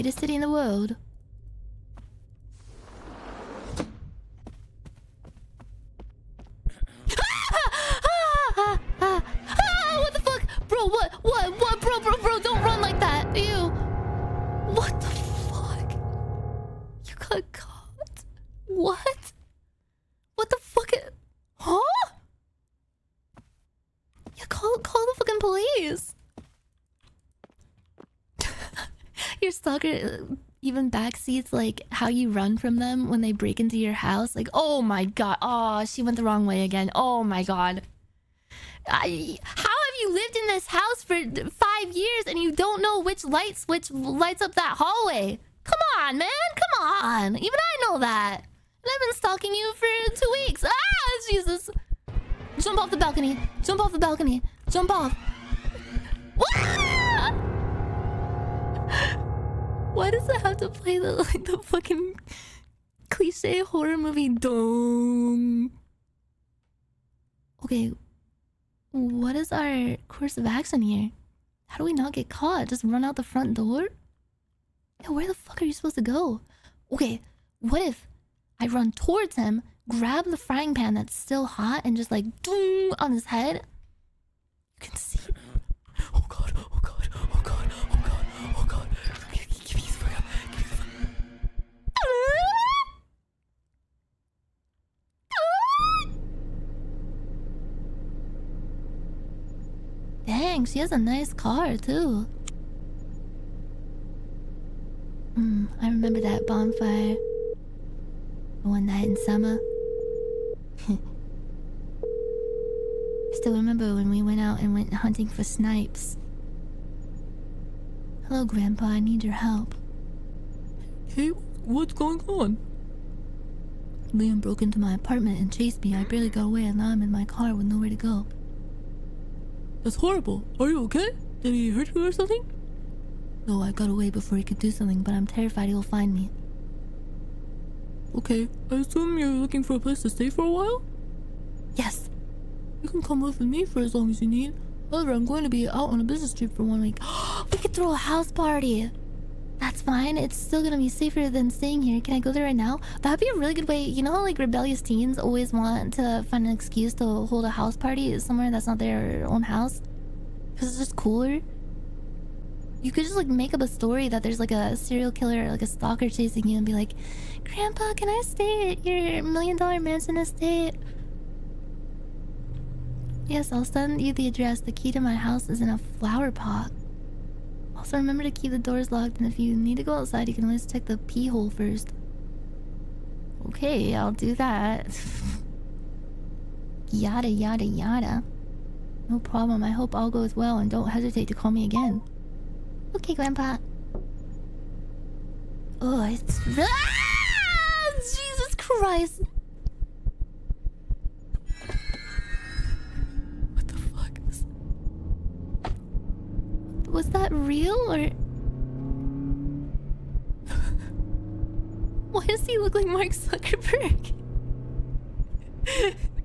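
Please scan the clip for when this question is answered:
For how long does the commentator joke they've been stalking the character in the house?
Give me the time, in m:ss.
0:50.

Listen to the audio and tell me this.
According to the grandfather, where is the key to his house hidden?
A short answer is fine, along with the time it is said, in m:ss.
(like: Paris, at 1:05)
In a flower pot, at 2:55.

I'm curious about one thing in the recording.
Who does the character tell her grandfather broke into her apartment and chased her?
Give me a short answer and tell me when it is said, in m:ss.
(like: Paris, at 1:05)
Liam, at 2:04.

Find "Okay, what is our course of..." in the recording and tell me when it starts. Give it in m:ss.
1:07.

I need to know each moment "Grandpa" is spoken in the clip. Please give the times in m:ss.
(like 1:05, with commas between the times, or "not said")
1:58, 2:47, 3:13.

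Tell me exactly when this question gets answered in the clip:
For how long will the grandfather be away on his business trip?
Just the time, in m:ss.
2:26.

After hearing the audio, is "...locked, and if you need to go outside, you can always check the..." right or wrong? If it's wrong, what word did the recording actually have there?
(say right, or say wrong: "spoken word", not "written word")
right.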